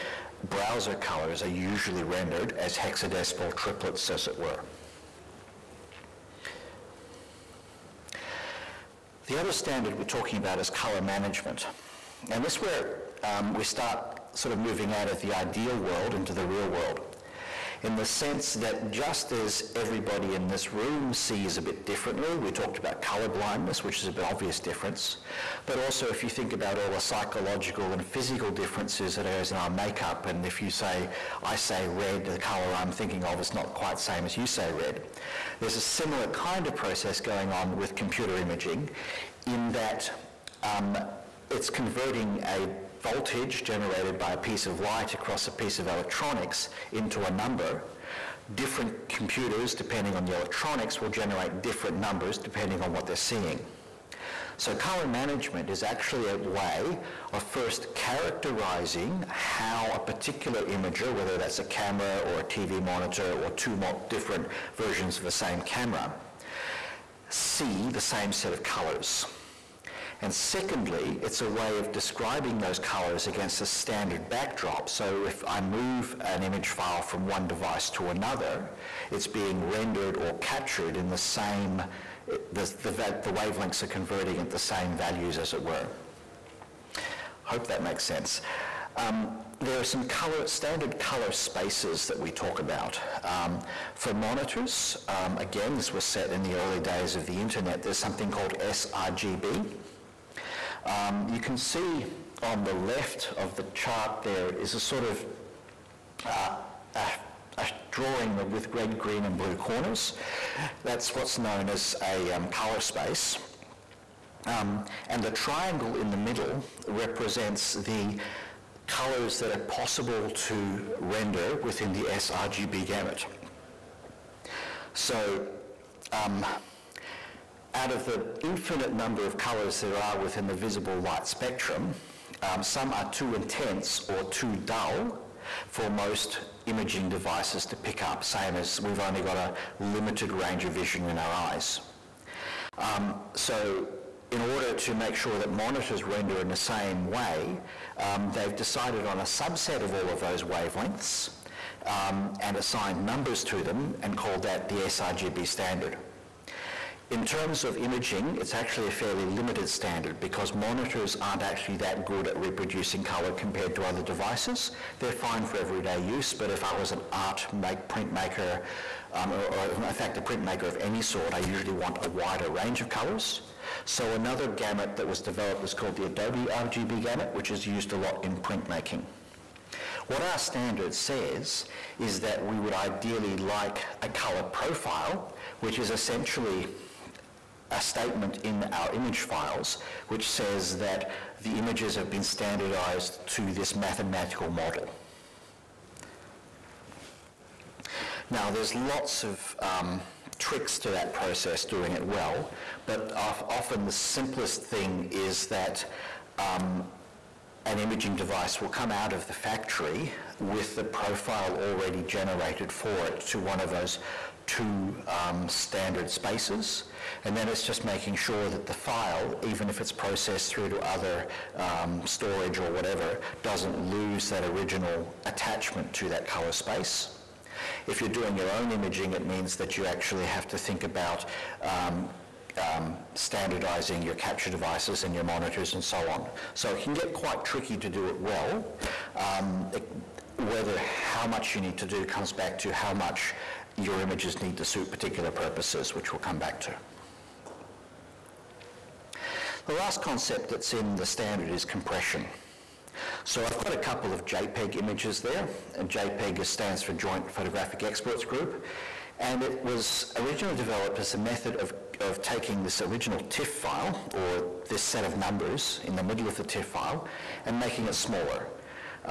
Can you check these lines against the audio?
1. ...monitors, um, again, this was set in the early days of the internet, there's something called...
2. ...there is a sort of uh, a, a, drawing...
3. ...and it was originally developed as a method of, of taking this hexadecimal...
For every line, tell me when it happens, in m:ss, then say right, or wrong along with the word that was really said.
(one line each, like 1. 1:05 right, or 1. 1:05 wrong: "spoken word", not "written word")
1. 1:34 right
2. 1:44 right
3. 4:19 wrong: "original", not "hexadecimal".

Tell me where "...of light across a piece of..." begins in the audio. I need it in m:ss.
0:44.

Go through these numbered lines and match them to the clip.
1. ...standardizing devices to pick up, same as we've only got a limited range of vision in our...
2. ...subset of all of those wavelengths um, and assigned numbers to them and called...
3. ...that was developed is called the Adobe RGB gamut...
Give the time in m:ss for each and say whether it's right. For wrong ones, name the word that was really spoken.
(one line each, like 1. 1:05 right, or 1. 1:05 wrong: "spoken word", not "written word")
1. 2:16 wrong: "imaging", not "standardizing"
2. 2:29 right
3. 2:54 right.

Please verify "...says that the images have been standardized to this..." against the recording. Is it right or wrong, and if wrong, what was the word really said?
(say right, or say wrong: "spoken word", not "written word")
right.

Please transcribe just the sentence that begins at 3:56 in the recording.
So it can get quite tricky to do it well.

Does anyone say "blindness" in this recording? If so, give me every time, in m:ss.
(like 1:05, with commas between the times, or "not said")
0:23.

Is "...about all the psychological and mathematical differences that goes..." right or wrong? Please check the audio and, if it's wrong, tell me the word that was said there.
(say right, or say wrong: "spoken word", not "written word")
wrong: "physical", not "mathematical".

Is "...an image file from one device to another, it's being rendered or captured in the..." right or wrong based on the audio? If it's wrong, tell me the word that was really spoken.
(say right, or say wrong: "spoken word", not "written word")
right.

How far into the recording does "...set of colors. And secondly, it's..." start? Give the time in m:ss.
1:08.